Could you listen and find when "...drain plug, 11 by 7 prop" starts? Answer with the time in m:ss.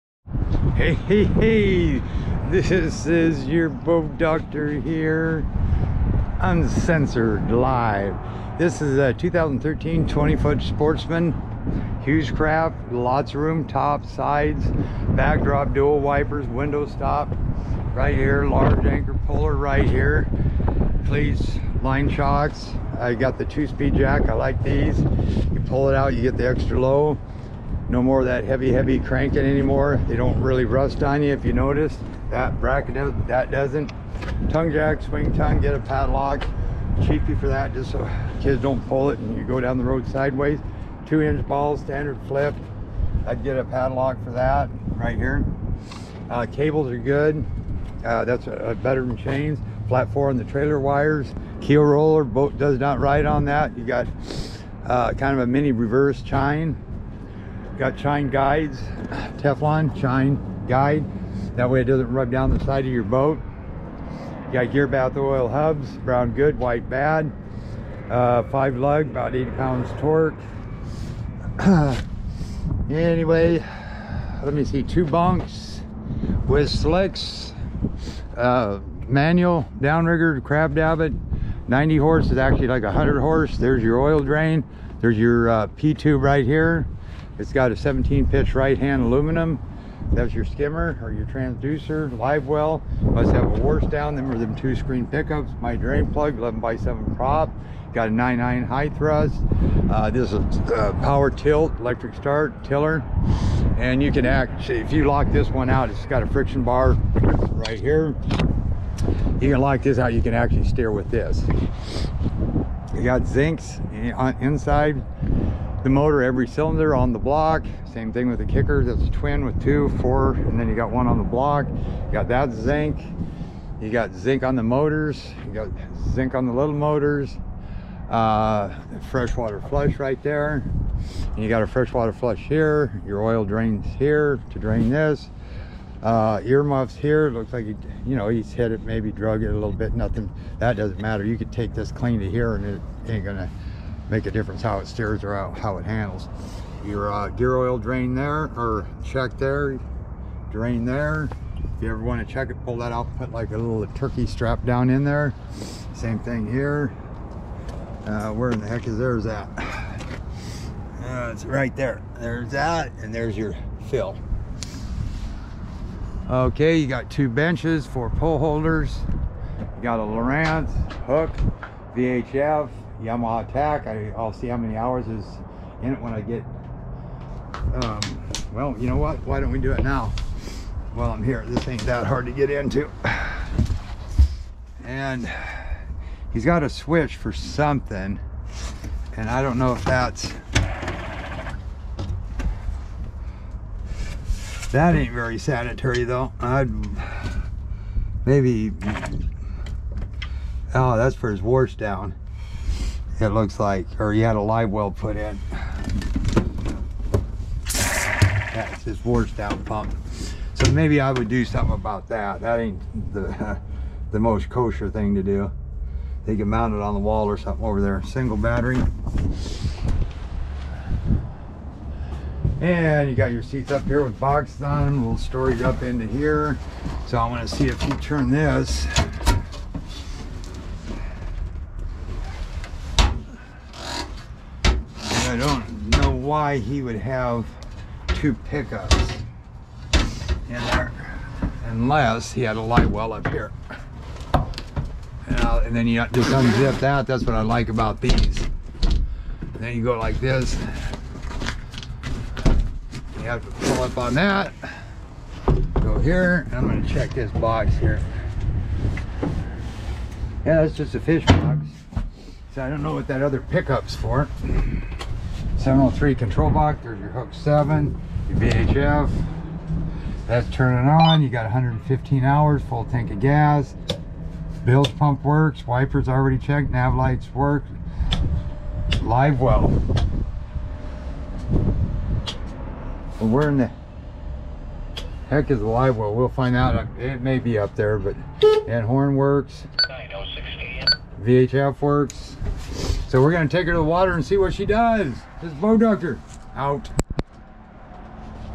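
1:35.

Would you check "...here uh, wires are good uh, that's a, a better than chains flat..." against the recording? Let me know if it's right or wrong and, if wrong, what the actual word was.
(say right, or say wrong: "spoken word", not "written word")
wrong: "cables", not "wires".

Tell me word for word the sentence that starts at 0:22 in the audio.
I got the two-speed jack, I like these.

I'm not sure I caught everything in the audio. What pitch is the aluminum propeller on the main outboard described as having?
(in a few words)
17.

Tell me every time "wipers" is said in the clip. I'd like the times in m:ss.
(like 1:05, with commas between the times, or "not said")
0:15, 4:35.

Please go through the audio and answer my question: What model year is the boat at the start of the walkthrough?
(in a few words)
2013.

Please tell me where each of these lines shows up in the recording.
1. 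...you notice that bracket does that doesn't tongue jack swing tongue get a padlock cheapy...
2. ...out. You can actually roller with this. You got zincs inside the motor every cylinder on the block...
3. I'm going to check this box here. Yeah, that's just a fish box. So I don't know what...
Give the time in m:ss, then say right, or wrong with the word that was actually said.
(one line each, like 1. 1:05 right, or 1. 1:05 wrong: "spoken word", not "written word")
1. 0:31 right
2. 1:49 wrong: "steer", not "roller"
3. 4:16 right.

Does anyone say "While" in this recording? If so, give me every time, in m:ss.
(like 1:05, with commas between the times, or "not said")
3:00.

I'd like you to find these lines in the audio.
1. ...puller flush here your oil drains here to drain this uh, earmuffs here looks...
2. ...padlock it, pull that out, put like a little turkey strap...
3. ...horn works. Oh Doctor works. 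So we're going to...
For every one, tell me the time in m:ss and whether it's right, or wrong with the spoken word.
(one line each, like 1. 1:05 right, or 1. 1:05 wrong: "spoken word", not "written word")
1. 2:11 wrong: "freshwater", not "puller"
2. 2:32 wrong: "check", not "padlock"
3. 4:48 wrong: "VHF", not "Doctor".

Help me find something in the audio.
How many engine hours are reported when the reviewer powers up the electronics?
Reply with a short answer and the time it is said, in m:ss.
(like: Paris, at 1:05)
115, at 4:31.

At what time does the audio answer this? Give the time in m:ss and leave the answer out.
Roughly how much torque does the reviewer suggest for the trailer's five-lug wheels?
1:09.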